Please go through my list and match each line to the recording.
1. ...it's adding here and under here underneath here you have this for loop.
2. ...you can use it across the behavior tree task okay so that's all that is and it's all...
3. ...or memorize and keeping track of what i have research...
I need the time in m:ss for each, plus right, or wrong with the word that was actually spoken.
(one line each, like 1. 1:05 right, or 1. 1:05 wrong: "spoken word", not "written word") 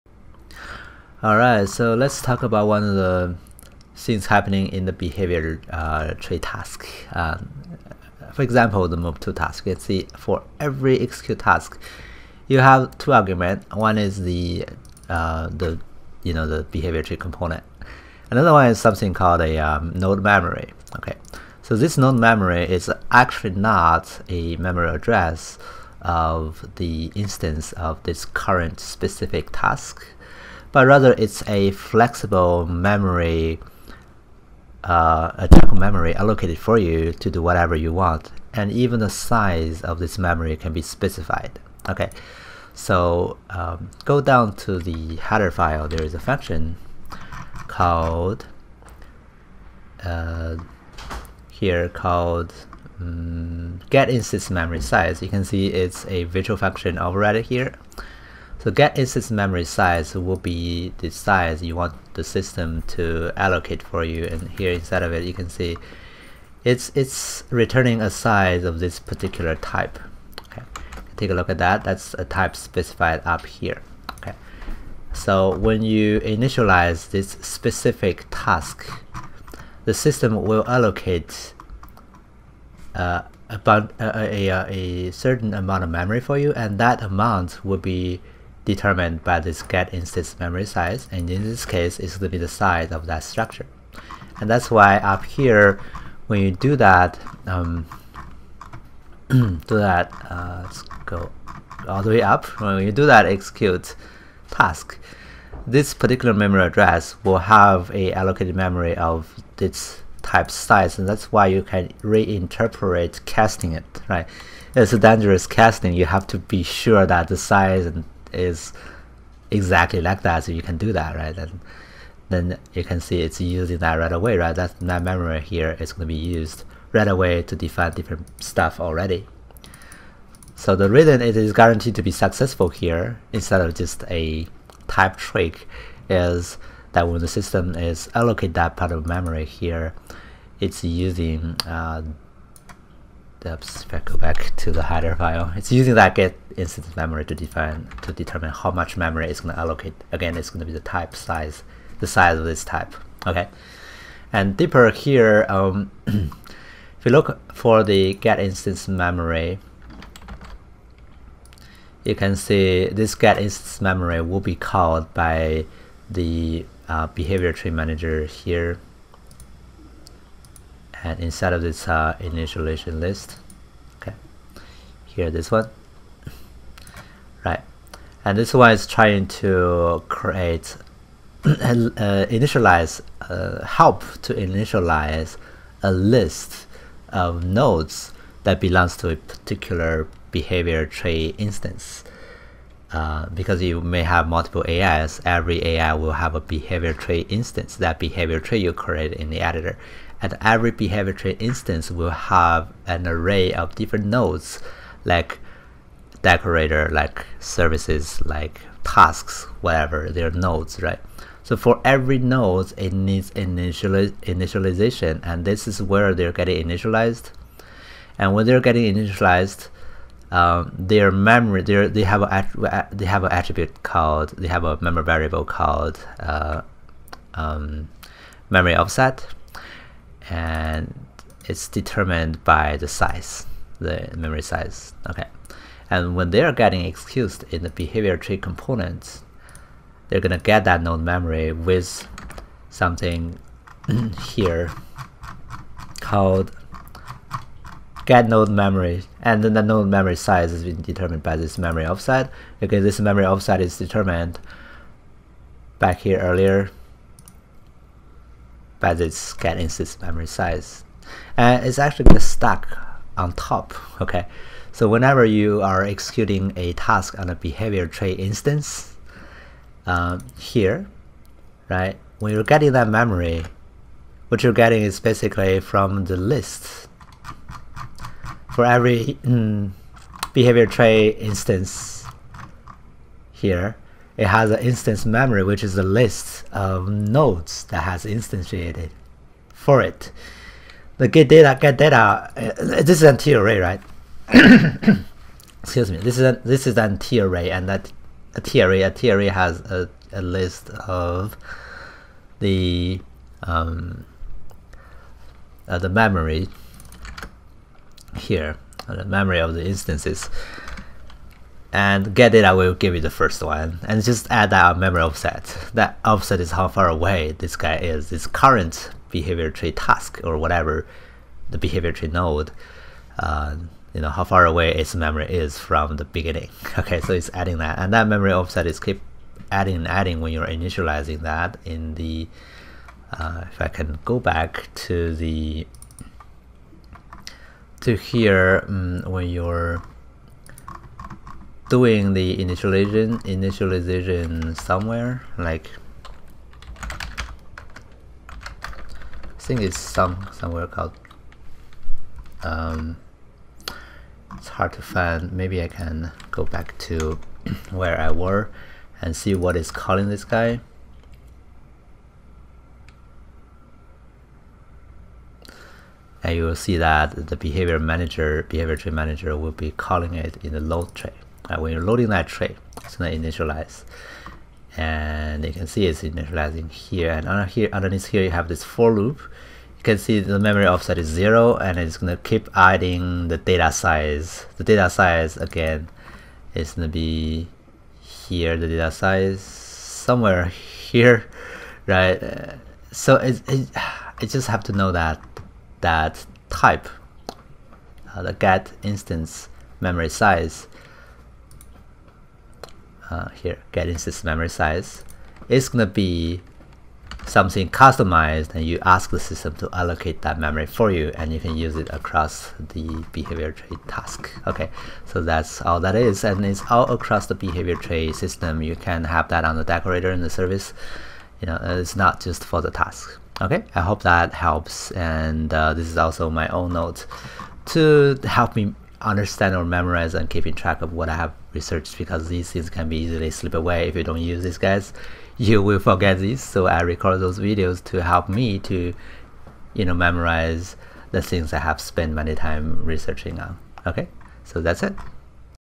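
1. 6:15 wrong: "initializing", not "adding"
2. 6:51 right
3. 7:09 right.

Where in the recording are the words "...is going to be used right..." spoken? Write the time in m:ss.
2:05.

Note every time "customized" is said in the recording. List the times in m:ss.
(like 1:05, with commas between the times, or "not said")
6:47.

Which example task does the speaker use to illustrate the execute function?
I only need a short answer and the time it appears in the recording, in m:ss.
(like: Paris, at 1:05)
Move to task, at 0:08.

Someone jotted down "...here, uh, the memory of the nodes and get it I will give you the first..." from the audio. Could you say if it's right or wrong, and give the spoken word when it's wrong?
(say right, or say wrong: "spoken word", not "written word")
wrong: "instances", not "nodes".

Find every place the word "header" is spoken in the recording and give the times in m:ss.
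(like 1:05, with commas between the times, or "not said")
0:45, 2:24.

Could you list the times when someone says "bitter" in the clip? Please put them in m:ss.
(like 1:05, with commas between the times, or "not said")
not said.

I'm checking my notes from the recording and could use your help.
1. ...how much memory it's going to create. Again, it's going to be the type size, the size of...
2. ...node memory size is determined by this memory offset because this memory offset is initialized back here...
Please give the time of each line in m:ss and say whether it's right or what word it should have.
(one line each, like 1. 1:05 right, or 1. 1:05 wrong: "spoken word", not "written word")
1. 2:28 wrong: "allocate", not "create"
2. 4:09 wrong: "determined", not "initialized".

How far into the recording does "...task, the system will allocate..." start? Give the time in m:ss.
1:18.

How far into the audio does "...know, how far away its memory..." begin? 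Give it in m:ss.
5:24.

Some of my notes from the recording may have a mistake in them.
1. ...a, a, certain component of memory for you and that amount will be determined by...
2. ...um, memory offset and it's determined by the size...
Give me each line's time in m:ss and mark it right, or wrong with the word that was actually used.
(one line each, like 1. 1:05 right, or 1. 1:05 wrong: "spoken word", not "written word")
1. 1:24 wrong: "amount", not "component"
2. 3:47 right.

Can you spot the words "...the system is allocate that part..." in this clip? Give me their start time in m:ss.
2:17.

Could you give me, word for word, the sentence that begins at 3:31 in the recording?
So for every node, it needs initialization, and this is where they're getting initialized.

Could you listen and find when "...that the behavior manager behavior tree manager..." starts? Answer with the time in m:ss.
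6:06.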